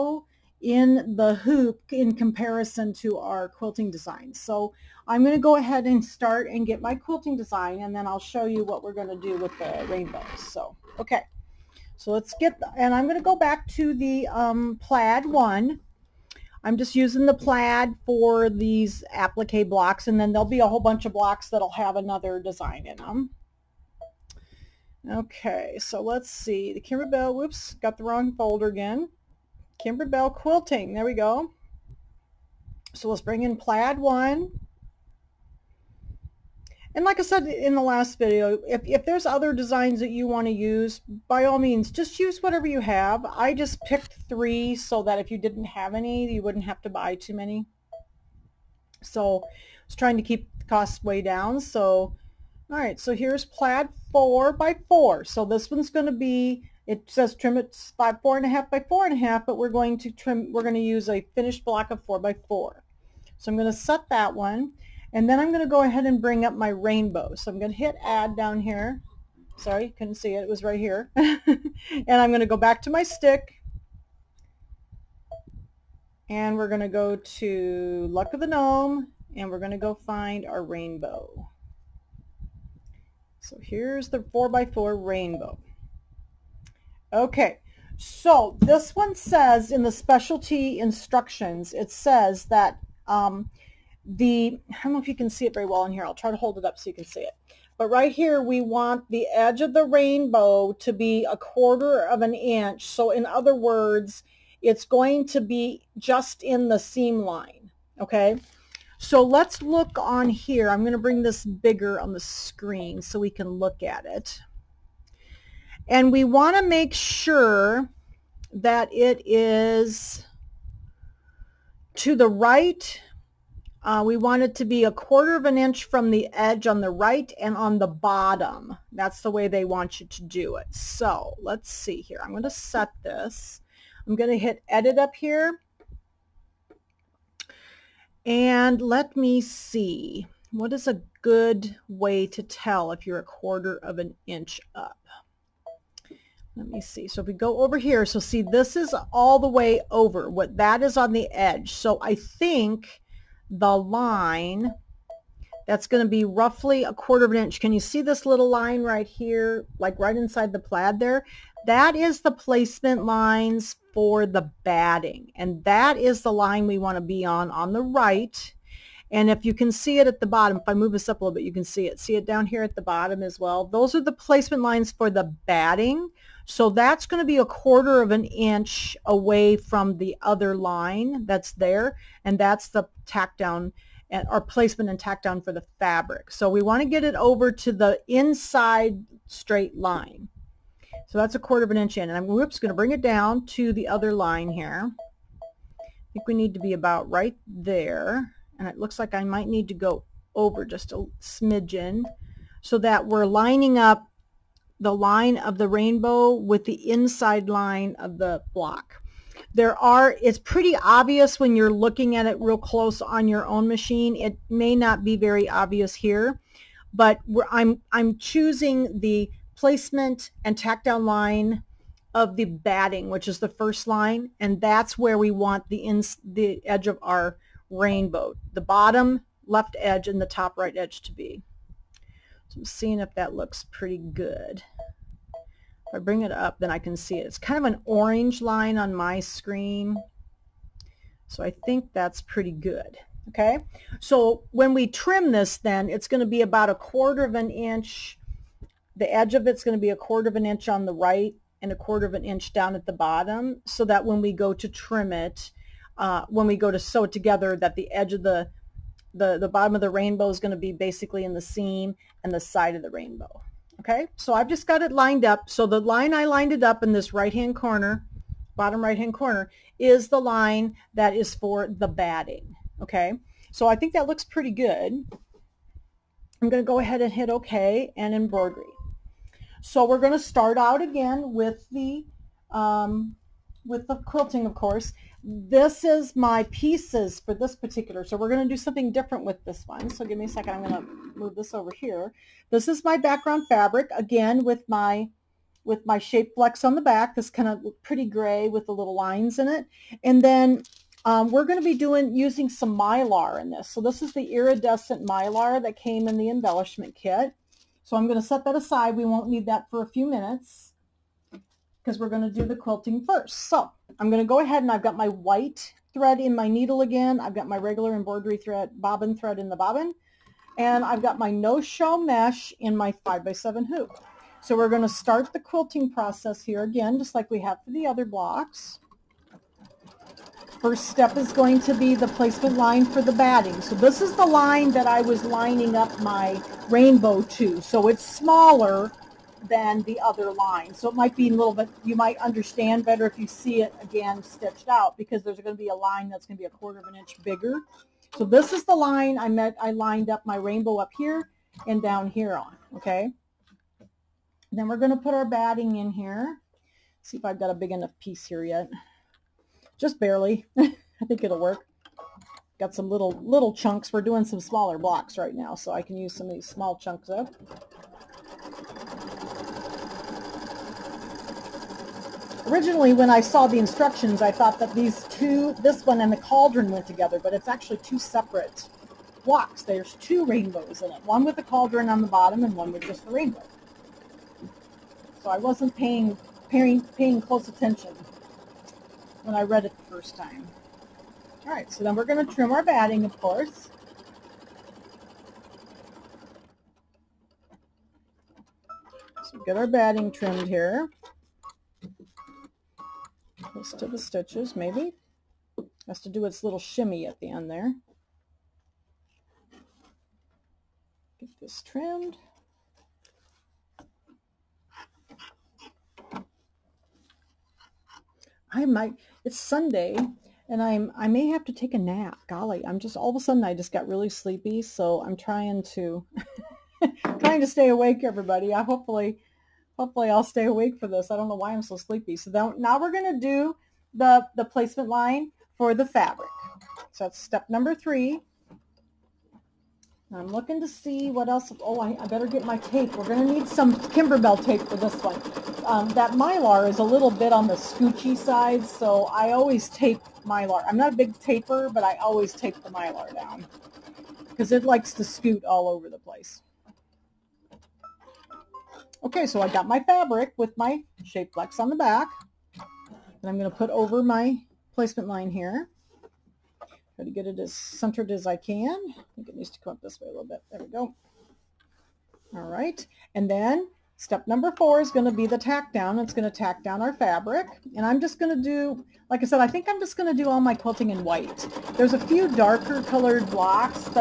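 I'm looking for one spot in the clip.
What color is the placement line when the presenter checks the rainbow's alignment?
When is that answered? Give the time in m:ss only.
3:57.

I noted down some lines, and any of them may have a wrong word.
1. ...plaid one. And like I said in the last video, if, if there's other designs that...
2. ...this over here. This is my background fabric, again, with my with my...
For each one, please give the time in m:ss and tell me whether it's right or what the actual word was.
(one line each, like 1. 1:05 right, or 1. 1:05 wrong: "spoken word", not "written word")
1. 0:33 right
2. 4:51 right.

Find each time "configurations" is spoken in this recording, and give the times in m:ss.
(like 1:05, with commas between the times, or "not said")
not said.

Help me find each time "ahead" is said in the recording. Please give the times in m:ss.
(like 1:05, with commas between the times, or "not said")
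0:05, 1:05, 4:36, 5:14.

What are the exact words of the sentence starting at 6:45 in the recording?
Has to do its little shimmy at the end there.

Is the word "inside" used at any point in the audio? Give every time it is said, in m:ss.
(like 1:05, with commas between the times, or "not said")
2:40, 3:08, 3:26.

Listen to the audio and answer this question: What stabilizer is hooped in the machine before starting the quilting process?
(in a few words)
no-show mesh.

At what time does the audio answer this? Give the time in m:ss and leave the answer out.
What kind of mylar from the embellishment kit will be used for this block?
5:04.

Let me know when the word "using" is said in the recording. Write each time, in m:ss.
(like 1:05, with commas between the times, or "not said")
0:16, 5:02.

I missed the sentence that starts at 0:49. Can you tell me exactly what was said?
So I was trying to keep the costs way down.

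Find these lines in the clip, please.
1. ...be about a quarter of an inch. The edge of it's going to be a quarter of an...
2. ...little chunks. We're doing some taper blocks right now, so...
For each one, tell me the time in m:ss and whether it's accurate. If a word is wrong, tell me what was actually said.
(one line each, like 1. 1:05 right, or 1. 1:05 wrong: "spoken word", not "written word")
1. 4:06 right
2. 6:03 wrong: "smaller", not "taper".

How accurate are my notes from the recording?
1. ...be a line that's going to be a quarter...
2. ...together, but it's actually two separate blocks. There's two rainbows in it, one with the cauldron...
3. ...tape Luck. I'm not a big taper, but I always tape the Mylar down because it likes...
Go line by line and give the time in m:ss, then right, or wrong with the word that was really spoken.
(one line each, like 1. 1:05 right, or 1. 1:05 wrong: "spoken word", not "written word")
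1. 5:45 right
2. 6:16 right
3. 7:29 wrong: "Mylar", not "Luck".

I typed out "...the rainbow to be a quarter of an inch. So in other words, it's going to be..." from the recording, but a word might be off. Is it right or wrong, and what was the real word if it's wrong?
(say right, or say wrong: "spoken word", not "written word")
right.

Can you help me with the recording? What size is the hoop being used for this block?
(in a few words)
5 by 7.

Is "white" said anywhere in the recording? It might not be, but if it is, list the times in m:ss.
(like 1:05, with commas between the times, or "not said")
5:15, 8:01.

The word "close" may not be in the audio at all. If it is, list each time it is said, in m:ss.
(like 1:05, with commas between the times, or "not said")
3:32, 6:27, 6:43.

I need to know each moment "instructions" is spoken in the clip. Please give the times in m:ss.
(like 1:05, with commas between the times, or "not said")
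1:30, 6:13.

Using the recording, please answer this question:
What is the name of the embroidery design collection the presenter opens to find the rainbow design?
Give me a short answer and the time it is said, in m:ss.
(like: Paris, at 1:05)
Luck of the Gnome, at 1:18.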